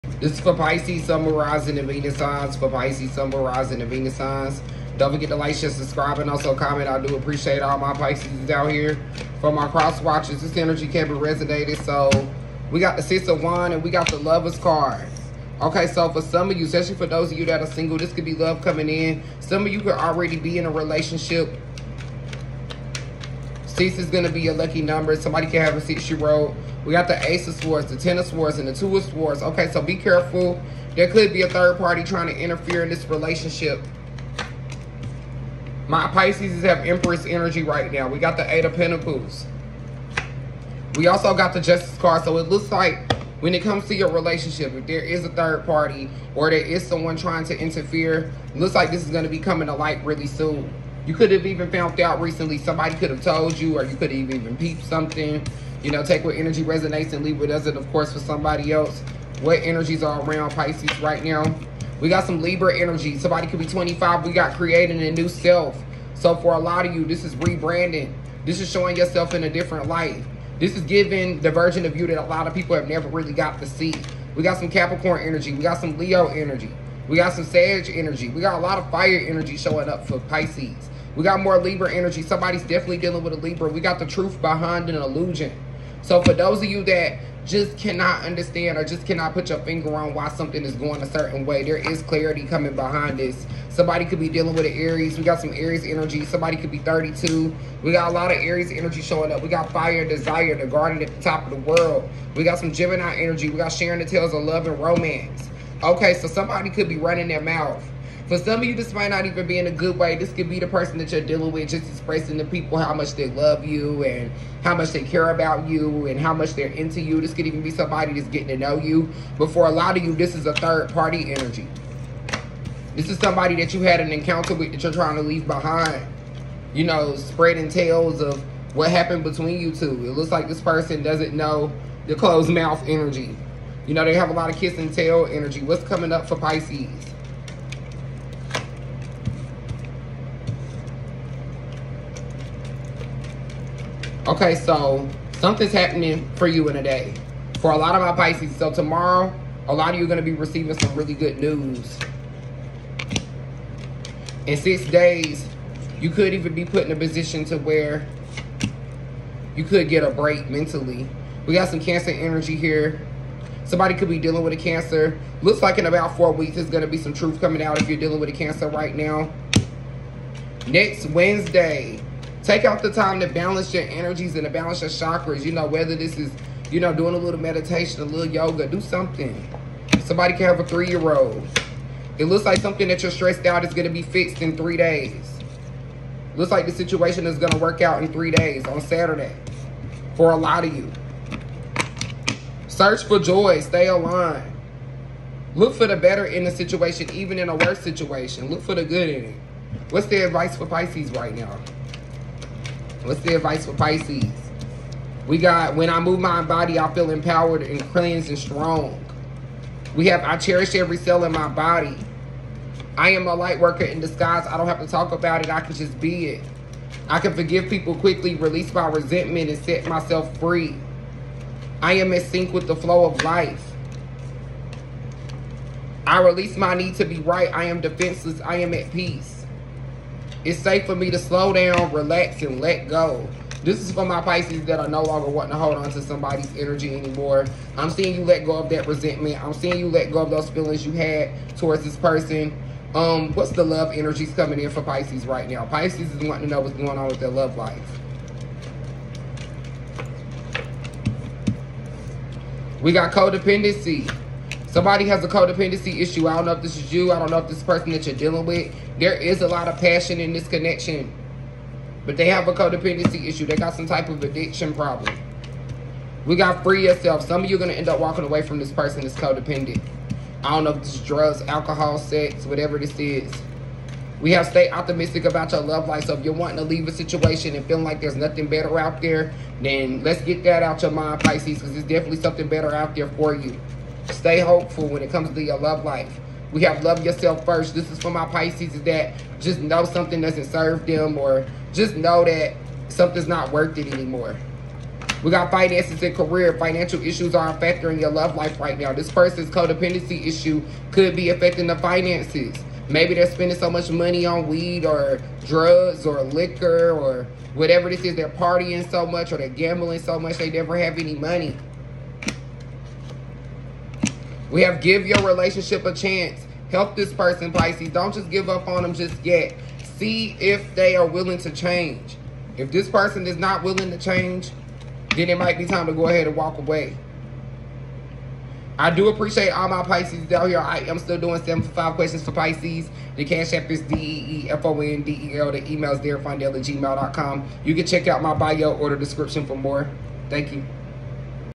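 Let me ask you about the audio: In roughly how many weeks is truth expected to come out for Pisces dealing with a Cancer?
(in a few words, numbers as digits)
4 weeks.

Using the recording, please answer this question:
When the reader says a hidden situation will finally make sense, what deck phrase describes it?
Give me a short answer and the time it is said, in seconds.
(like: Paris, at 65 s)
The truth behind an illusion, at 83 s.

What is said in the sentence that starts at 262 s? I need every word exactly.
But they have a codependency issue.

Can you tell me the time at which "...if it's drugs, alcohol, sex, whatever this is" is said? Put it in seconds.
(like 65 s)
270 s.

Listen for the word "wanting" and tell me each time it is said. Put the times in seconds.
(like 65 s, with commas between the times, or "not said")
235 s, 246 s, 276 s.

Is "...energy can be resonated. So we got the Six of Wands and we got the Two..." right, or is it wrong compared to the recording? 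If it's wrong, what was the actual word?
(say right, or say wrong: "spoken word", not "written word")
wrong: "Lovers", not "Two".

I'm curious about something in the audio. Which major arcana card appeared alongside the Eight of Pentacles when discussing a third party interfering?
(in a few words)
Justice.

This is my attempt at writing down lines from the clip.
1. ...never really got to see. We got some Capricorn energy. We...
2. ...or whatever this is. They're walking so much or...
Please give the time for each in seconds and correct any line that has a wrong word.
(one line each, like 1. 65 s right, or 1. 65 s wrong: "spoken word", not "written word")
1. 72 s right
2. 306 s wrong: "partying", not "walking".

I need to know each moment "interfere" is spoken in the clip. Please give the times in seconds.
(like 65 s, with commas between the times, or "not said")
32 s, 47 s.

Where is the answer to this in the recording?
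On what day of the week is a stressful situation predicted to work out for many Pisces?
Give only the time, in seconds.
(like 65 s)
188 s.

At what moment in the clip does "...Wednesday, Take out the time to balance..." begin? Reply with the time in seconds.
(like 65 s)
171 s.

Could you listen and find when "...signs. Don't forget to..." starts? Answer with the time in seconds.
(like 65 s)
4 s.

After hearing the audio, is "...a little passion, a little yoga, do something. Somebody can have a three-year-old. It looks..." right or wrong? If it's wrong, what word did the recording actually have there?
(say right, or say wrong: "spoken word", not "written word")
wrong: "meditation", not "passion".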